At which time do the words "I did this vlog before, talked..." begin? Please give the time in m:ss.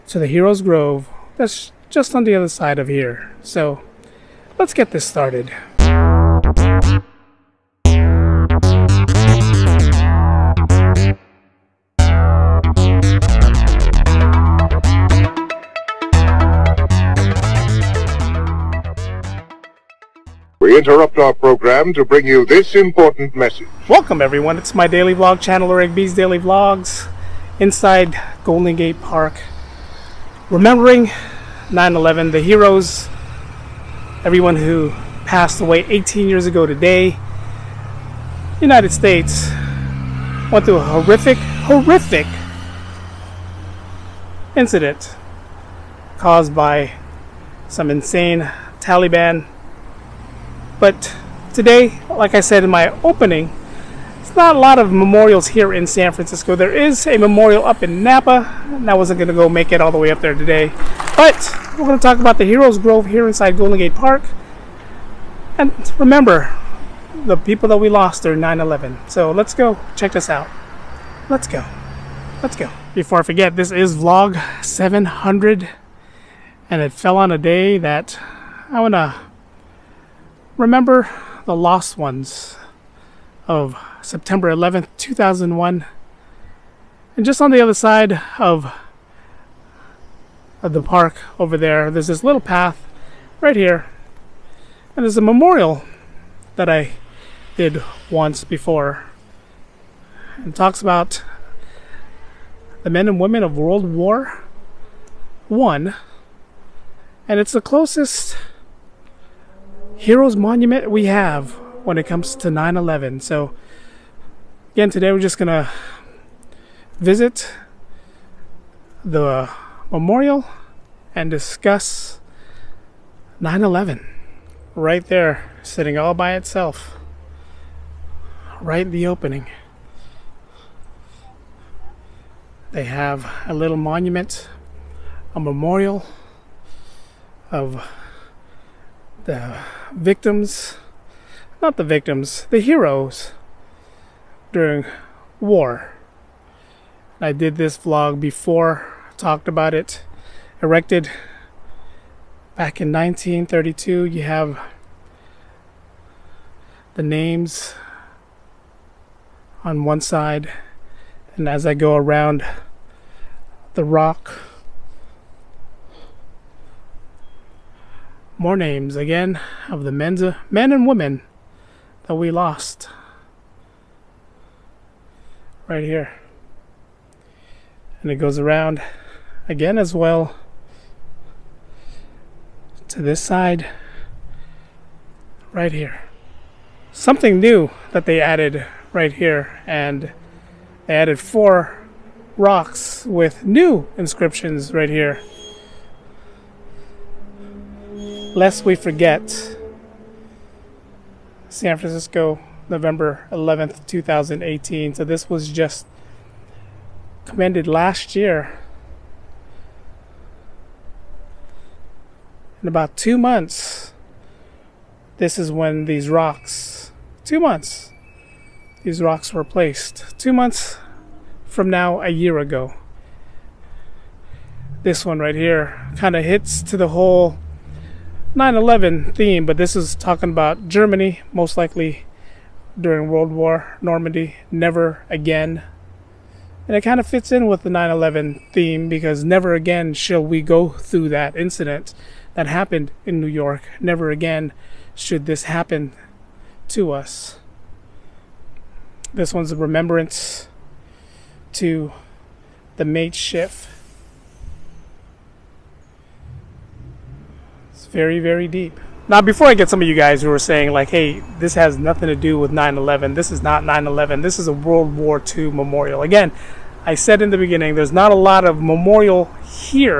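2:27.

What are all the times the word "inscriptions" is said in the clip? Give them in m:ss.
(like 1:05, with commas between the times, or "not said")
3:13.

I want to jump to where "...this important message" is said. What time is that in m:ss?
0:22.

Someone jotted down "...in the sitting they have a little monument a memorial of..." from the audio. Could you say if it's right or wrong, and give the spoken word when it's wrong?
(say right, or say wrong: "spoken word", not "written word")
wrong: "opening", not "sitting".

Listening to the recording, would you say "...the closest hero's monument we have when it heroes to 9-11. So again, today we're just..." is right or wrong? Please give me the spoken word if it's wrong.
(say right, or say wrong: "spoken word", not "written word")
wrong: "comes", not "heroes".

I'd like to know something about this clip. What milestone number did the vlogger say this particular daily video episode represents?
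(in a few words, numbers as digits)
700.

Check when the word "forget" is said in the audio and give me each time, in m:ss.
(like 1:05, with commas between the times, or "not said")
1:13, 3:18.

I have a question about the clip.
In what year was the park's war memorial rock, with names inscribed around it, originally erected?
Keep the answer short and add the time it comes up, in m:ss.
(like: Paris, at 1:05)
1932, at 2:32.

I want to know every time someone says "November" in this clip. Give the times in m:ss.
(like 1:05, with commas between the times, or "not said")
3:22.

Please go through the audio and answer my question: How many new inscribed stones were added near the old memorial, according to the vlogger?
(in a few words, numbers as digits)
4.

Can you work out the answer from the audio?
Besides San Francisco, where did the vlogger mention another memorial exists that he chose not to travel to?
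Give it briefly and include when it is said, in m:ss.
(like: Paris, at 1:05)
Napa, at 0:58.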